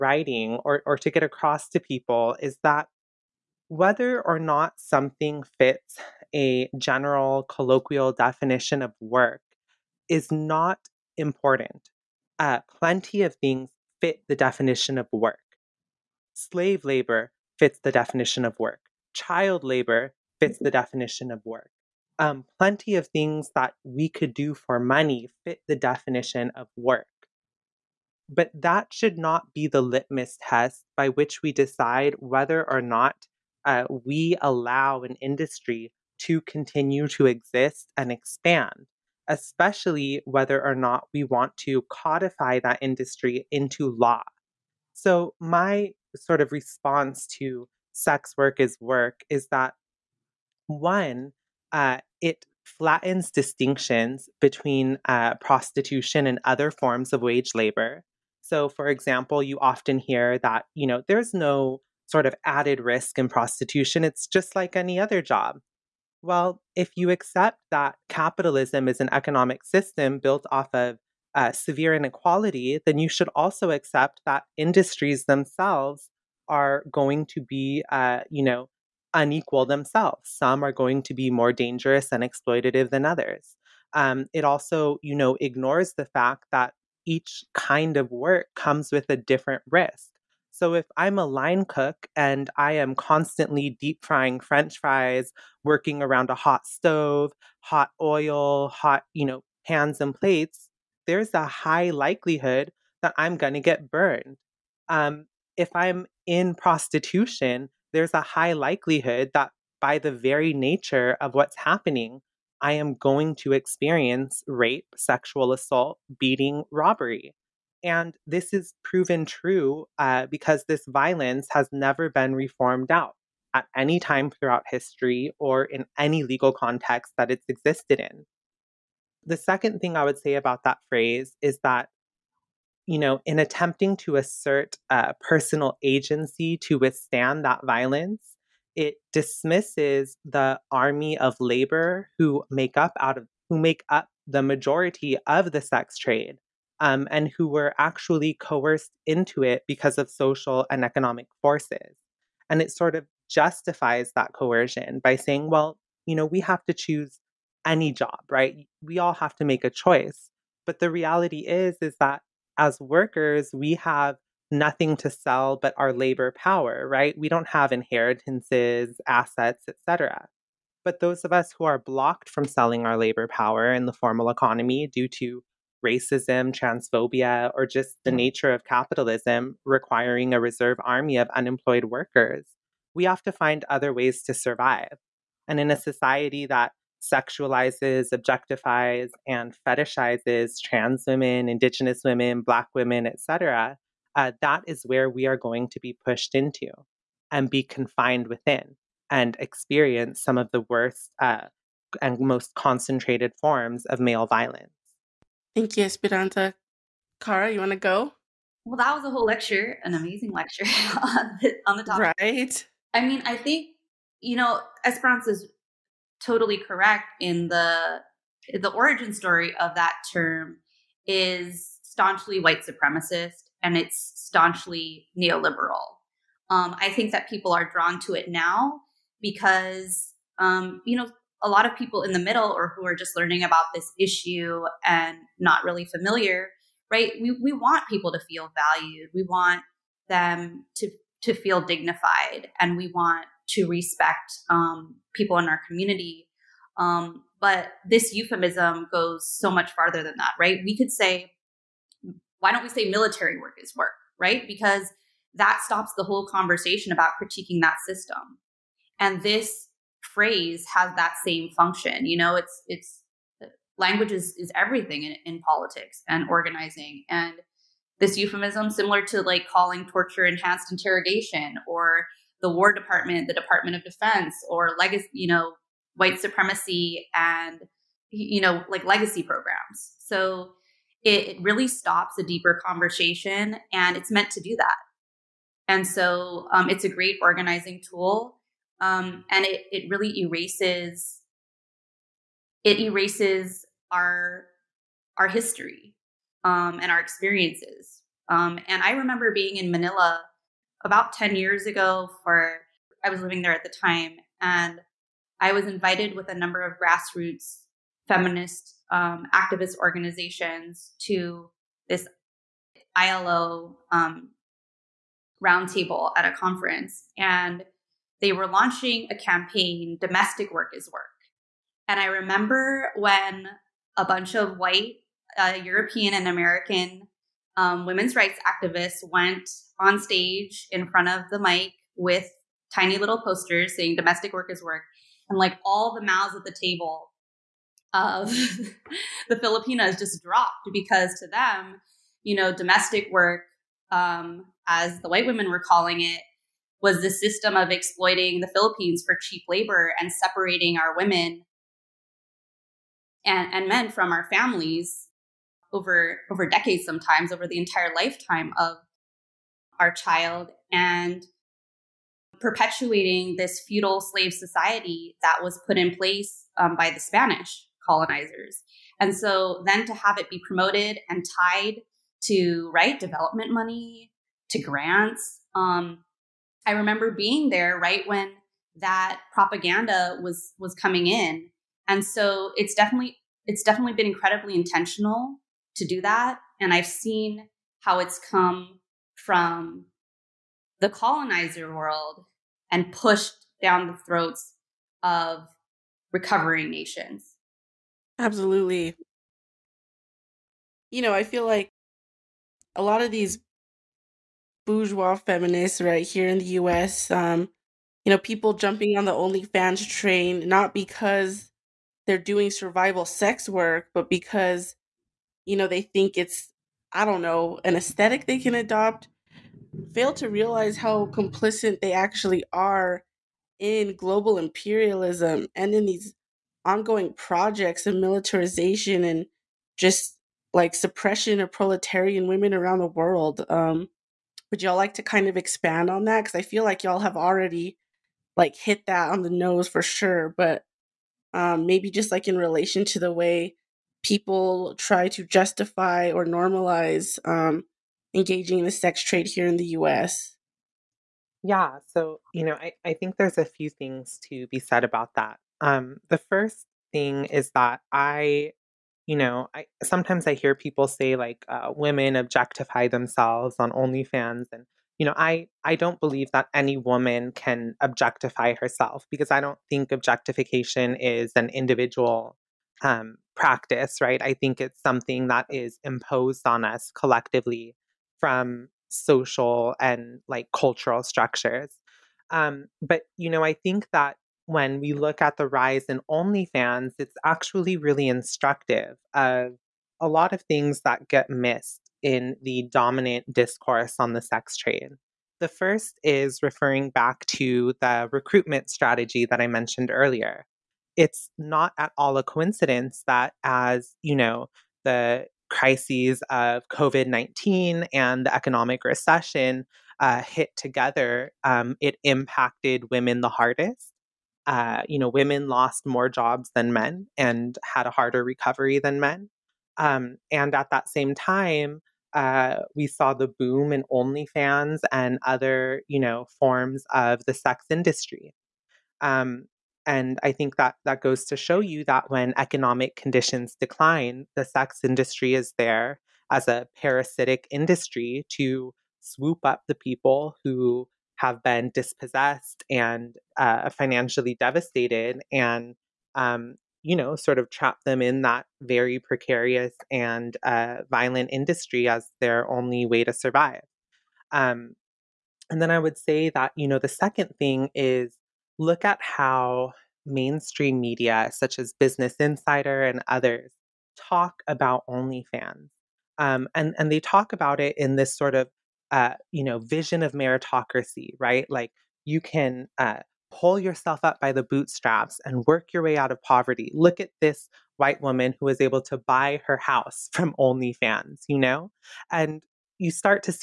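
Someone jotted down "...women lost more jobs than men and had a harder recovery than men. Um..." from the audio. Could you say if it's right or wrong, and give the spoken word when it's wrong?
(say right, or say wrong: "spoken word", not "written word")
right.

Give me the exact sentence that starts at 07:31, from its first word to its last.
Yeah, so, you know, I, I think there's a few things to be said about that.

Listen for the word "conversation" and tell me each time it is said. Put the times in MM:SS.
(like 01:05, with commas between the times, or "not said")
04:16, 04:42.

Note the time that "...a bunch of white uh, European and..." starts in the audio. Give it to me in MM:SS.
05:23.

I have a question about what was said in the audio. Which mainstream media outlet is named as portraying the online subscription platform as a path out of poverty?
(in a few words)
Business Insider.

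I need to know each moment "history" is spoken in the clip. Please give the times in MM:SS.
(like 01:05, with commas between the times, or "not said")
02:04, 04:55.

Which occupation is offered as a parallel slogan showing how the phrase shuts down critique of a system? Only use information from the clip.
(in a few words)
military work.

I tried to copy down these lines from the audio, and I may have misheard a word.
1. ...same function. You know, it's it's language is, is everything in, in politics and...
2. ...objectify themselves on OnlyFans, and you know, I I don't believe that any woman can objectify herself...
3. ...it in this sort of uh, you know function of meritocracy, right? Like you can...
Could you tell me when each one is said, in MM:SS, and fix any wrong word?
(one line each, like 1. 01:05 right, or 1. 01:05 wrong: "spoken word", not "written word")
1. 04:21 right
2. 07:42 right
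3. 09:27 wrong: "vision", not "function".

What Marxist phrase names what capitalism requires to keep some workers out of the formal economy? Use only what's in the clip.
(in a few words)
reserve army of unemployed workers.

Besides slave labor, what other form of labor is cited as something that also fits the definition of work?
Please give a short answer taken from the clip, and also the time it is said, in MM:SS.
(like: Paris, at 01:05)
Child labor, at 00:19.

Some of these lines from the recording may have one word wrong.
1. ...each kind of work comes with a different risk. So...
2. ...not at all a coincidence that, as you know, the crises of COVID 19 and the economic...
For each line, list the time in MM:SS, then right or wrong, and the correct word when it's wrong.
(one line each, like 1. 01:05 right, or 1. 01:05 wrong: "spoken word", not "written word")
1. 01:27 right
2. 08:21 right.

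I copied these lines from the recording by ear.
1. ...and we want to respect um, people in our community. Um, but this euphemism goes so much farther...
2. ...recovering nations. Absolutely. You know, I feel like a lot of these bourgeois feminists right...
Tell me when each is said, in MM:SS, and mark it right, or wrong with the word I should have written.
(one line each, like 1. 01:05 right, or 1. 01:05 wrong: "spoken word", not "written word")
1. 04:02 right
2. 06:36 right.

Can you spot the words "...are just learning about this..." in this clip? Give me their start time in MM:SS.
03:52.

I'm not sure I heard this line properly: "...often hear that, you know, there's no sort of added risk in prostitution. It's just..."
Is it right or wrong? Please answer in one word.
right.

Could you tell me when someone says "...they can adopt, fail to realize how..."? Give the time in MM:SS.
06:58.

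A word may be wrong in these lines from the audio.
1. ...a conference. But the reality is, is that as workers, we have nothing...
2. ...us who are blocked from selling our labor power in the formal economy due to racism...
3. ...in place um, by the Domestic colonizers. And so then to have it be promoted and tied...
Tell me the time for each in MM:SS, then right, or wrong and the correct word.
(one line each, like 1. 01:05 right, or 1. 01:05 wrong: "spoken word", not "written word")
1. 02:39 wrong: "choice", not "conference"
2. 02:51 right
3. 06:05 wrong: "Spanish", not "Domestic".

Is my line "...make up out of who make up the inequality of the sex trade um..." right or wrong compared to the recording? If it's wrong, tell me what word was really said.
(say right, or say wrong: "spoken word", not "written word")
wrong: "majority", not "inequality".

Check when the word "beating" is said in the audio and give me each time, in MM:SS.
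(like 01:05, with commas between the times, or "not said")
01:56.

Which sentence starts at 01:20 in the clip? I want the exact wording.
Some are going to be more dangerous and exploitative than others.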